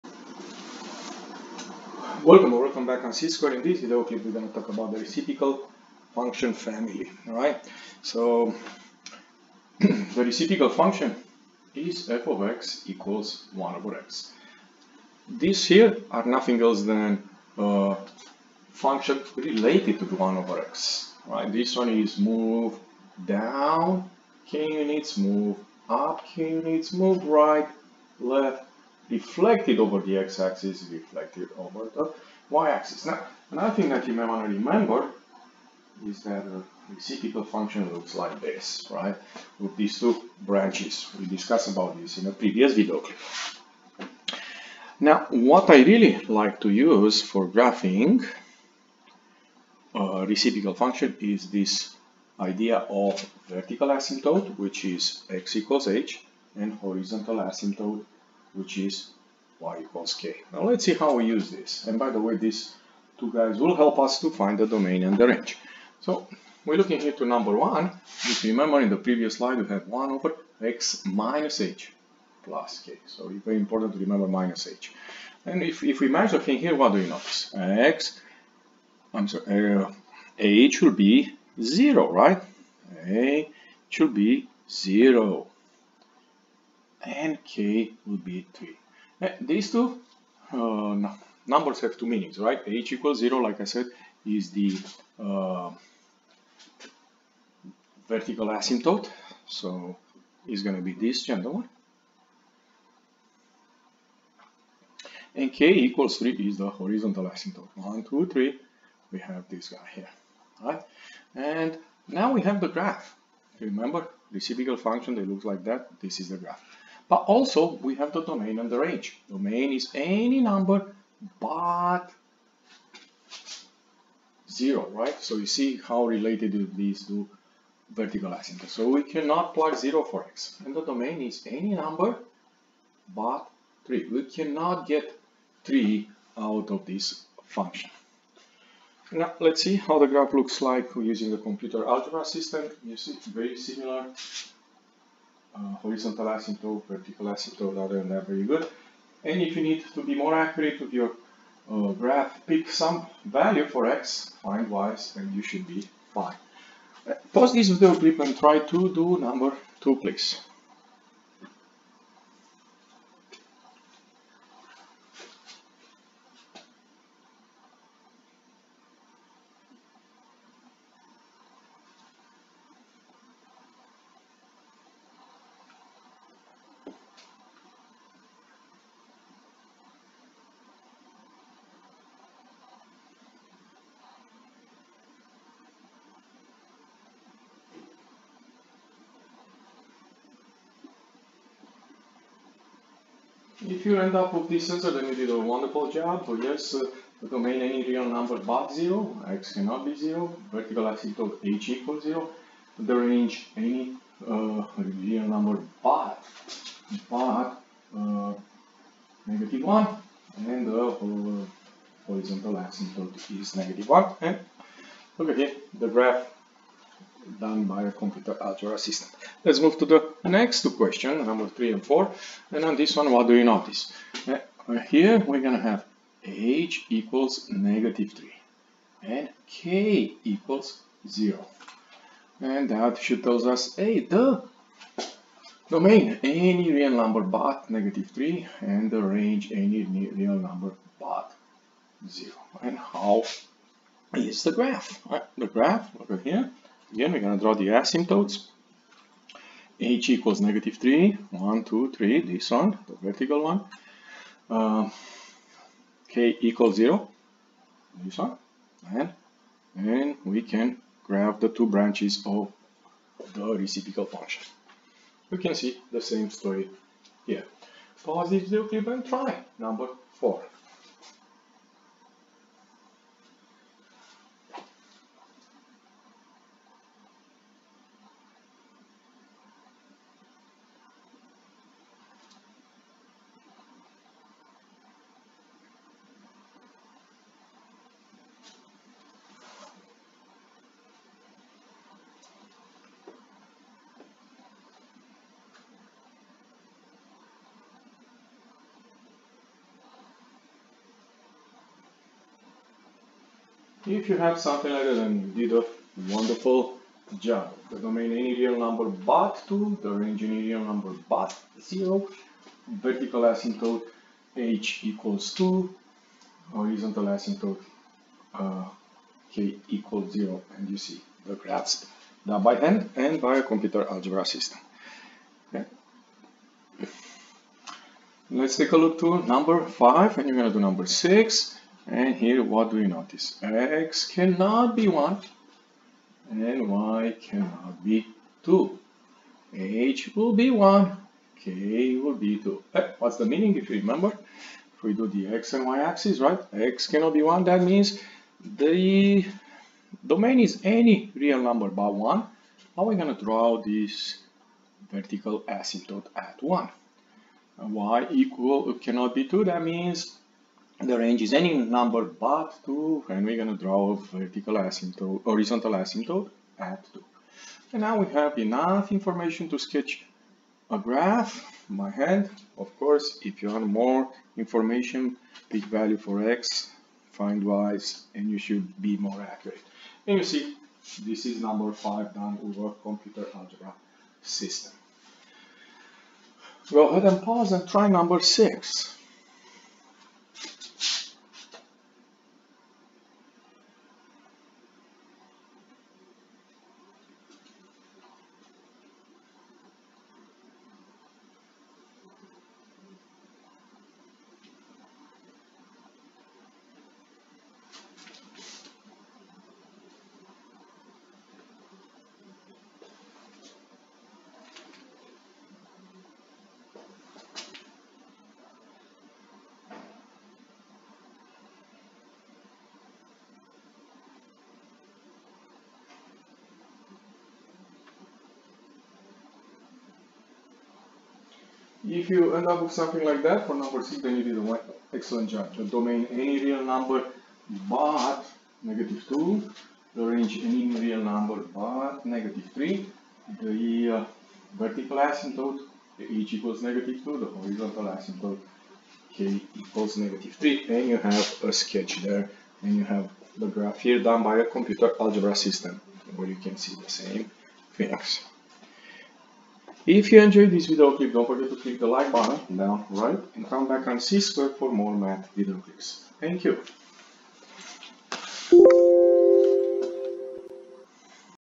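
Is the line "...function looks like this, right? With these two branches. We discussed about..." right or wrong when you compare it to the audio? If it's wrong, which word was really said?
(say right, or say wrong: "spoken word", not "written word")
right.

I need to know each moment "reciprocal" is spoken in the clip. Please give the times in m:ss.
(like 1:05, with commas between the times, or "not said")
0:04, 0:10, 0:36, 0:50, 4:23.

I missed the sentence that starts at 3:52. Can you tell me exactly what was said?
And that should tell us, hey, the domain, any real number but negative 3 and the range, any real number but 0.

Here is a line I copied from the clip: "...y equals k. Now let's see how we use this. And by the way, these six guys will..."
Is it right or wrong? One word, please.
wrong.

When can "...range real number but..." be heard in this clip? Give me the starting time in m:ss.
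5:09.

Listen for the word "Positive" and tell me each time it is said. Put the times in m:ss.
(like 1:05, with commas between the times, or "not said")
4:28.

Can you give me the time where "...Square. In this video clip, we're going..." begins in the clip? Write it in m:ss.
0:03.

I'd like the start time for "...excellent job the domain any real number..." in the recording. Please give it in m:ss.
7:14.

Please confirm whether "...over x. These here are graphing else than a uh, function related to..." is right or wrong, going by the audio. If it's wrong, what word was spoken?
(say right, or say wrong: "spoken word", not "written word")
wrong: "nothing", not "graphing".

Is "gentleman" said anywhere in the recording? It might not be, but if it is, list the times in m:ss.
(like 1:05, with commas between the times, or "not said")
1:41.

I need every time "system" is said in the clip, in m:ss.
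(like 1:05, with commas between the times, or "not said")
2:22, 3:38, 5:24, 6:24, 7:35.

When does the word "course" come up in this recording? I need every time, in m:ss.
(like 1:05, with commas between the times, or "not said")
6:12.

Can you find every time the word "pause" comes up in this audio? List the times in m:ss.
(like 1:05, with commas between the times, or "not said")
2:37, 6:27.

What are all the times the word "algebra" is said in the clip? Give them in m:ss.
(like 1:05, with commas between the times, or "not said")
2:21, 3:38, 5:23, 6:23, 7:34.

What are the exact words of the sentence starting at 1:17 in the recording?
x, I'm sorry, uh, h will be 0, right?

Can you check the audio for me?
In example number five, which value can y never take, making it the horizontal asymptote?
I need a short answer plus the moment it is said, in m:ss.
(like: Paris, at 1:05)
2, at 5:36.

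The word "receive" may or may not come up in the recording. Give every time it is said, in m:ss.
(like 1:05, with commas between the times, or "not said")
not said.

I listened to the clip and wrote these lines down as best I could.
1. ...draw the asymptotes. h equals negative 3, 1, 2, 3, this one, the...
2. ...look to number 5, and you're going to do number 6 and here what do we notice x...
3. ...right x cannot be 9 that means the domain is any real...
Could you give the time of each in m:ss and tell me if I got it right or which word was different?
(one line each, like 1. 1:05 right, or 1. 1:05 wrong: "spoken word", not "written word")
1. 4:07 right
2. 5:28 right
3. 5:46 wrong: "1", not "9".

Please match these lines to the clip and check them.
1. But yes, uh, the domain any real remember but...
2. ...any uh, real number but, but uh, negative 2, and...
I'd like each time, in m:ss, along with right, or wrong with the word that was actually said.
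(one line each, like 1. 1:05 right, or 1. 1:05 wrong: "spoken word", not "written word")
1. 3:16 wrong: "number", not "remember"
2. 3:23 wrong: "1", not "2".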